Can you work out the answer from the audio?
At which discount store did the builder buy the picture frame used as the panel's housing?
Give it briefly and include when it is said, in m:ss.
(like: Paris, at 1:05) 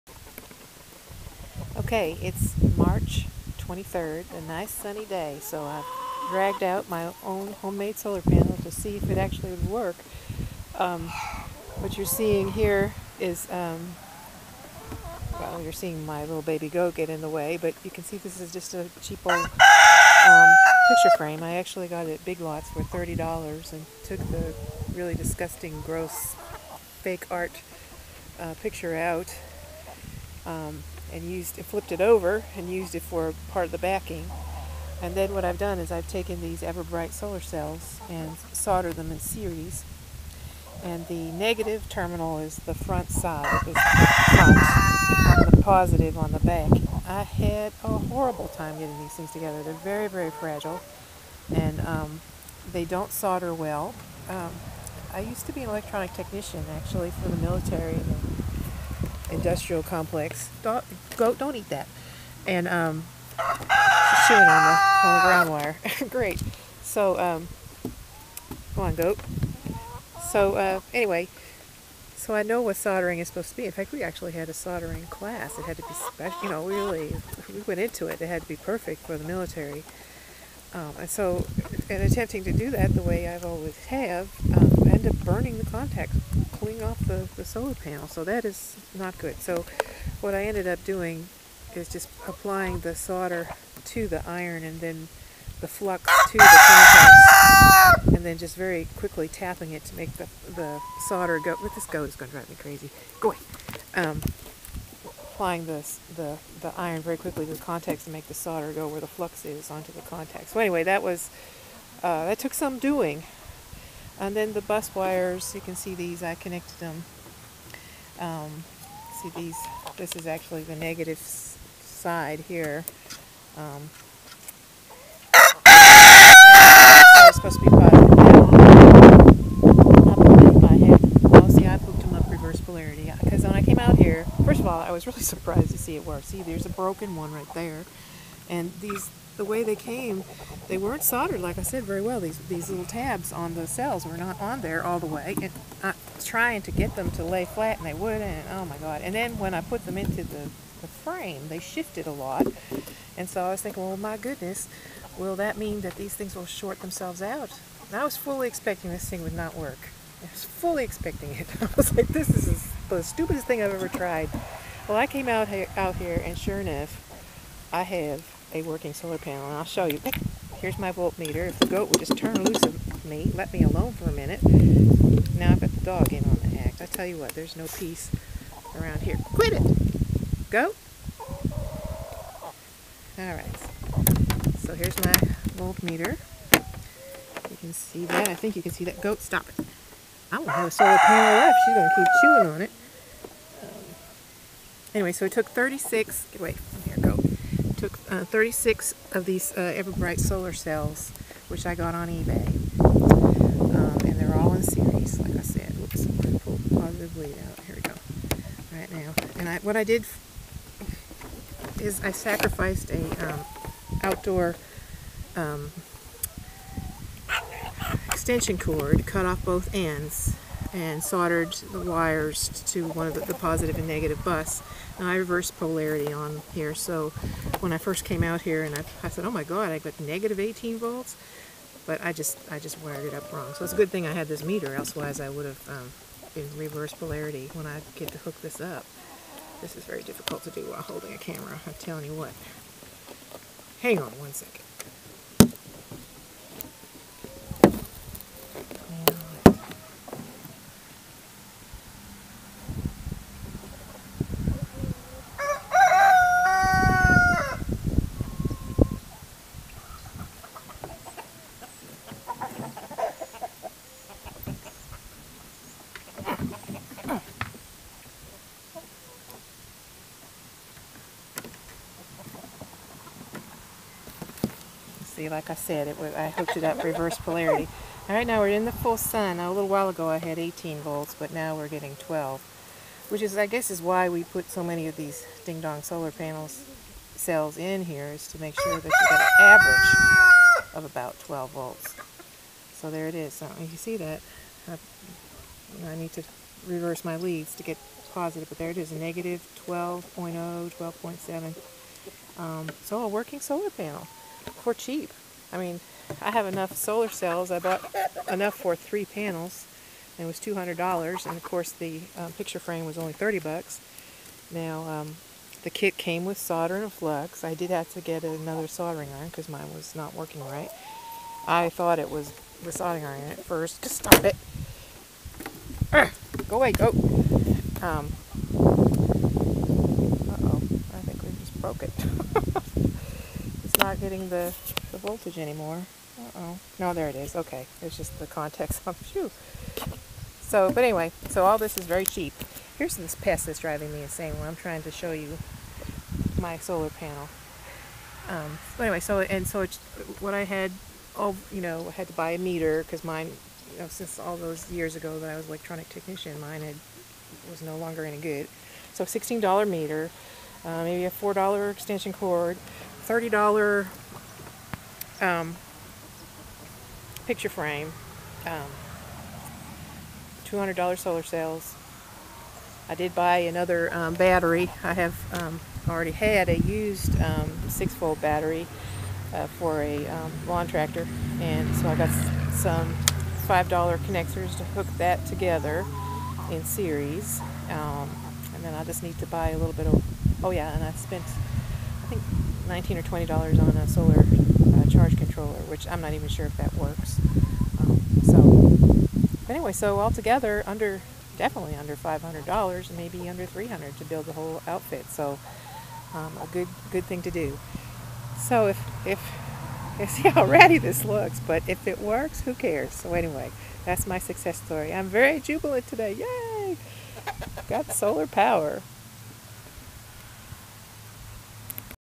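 Big Lots, at 0:22.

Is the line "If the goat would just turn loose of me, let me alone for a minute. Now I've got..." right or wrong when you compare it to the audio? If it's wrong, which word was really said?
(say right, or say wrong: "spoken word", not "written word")
right.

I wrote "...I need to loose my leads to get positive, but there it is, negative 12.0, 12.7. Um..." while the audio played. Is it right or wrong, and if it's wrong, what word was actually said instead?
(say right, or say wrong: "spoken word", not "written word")
wrong: "reverse", not "loose".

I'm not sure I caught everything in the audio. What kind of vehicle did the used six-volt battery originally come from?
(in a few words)
lawn tractor.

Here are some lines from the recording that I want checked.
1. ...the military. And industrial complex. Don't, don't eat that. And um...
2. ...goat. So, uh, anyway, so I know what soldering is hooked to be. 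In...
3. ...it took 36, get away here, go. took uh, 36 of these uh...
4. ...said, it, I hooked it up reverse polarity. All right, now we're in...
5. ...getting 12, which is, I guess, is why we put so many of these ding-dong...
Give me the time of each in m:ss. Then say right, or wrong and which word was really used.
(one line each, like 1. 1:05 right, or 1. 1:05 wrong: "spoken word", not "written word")
1. 0:57 right
2. 1:08 wrong: "supposed", not "hooked"
3. 3:15 right
4. 4:35 right
5. 4:41 right.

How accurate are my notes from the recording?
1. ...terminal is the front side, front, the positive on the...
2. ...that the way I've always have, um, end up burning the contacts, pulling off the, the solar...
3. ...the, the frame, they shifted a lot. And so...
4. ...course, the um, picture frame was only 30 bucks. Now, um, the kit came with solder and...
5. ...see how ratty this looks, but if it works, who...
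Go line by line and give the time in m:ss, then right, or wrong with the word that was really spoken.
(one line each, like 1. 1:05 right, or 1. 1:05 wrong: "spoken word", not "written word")
1. 0:41 right
2. 1:22 right
3. 2:30 right
4. 5:11 right
5. 6:50 right.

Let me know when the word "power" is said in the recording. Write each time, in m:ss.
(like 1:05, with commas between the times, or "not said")
6:58.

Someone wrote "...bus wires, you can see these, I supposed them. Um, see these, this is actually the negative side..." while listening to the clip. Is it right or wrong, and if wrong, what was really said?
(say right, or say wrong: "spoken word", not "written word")
wrong: "connected", not "supposed".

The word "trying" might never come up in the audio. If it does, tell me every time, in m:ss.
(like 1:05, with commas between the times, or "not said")
2:26, 5:44.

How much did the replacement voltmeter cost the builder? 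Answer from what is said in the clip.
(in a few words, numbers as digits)
$16.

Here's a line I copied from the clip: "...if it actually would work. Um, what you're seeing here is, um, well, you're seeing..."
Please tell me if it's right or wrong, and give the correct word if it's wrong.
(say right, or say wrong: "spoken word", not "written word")
right.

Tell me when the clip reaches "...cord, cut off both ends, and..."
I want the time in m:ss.
3:38.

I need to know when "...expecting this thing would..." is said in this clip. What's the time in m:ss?
2:38.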